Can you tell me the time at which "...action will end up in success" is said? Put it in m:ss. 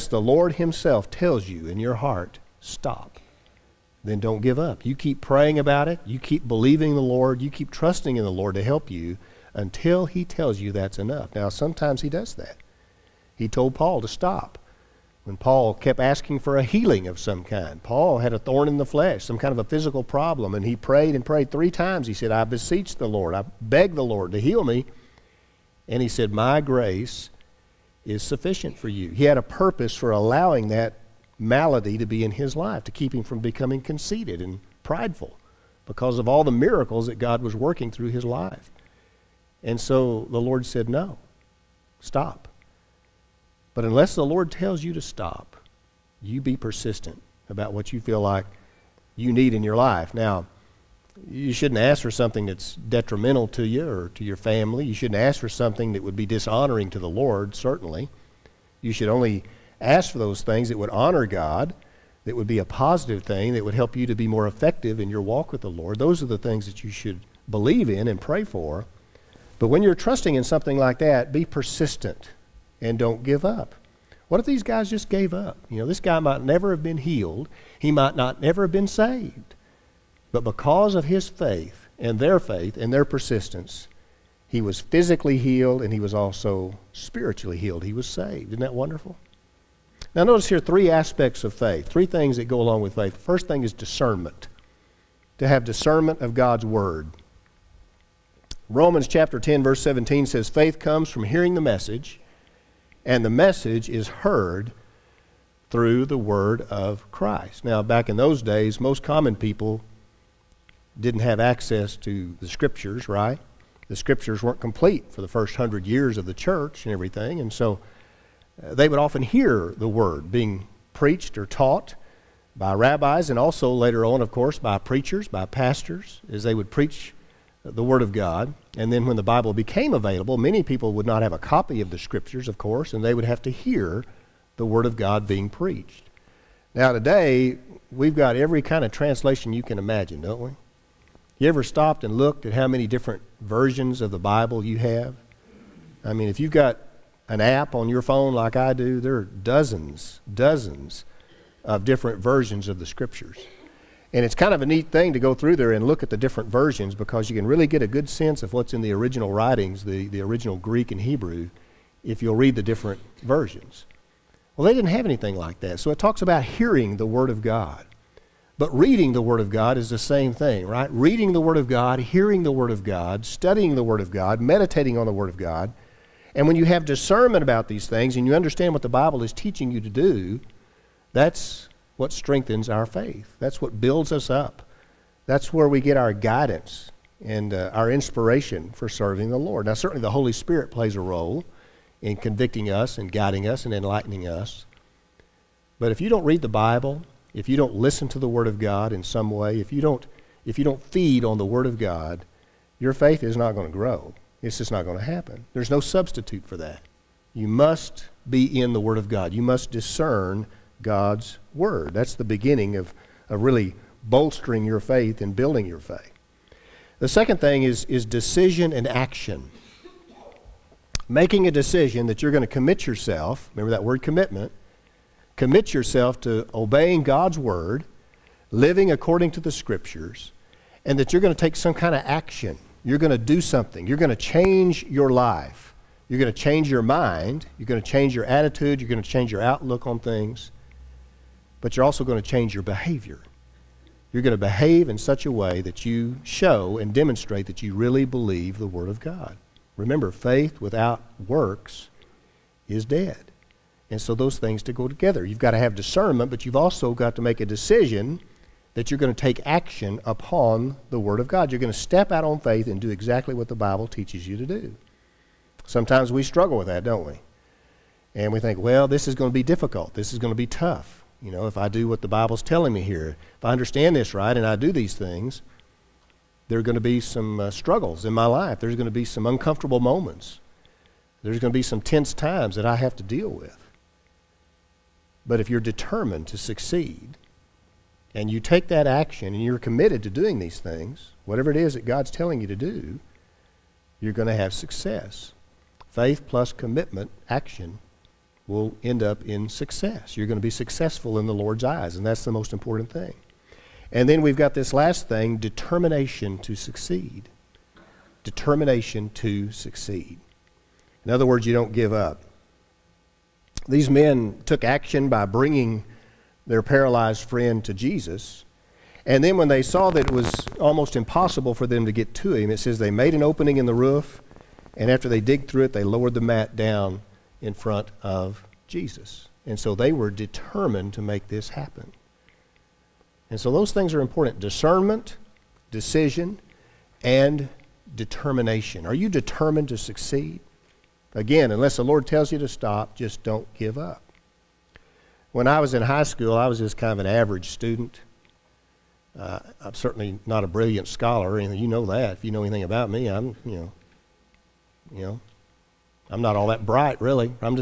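4:57.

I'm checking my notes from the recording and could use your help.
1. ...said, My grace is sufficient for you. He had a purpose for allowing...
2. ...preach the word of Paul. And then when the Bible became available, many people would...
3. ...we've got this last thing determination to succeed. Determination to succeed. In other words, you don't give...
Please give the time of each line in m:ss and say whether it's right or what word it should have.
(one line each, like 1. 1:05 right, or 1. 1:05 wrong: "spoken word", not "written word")
1. 0:26 right
2. 2:06 wrong: "God", not "Paul"
3. 5:04 right.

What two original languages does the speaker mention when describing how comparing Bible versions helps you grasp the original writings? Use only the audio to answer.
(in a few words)
Greek and Hebrew.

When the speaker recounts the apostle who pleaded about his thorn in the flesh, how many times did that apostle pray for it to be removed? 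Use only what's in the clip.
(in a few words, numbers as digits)
3.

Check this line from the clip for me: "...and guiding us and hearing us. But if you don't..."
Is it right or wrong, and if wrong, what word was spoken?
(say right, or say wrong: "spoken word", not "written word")
wrong: "enlightening", not "hearing".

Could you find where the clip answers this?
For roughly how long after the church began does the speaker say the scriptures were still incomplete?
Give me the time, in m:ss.
1:55.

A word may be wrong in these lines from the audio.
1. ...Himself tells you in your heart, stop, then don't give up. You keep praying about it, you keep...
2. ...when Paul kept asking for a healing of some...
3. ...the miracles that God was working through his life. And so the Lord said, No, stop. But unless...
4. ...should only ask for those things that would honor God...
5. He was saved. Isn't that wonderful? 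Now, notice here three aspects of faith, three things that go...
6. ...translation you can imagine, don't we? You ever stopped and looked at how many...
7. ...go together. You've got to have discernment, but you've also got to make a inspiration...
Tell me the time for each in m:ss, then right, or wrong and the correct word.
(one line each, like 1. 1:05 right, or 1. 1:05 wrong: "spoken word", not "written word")
1. 0:00 right
2. 0:15 right
3. 0:36 right
4. 0:58 right
5. 1:27 right
6. 2:18 right
7. 4:14 wrong: "decision", not "inspiration".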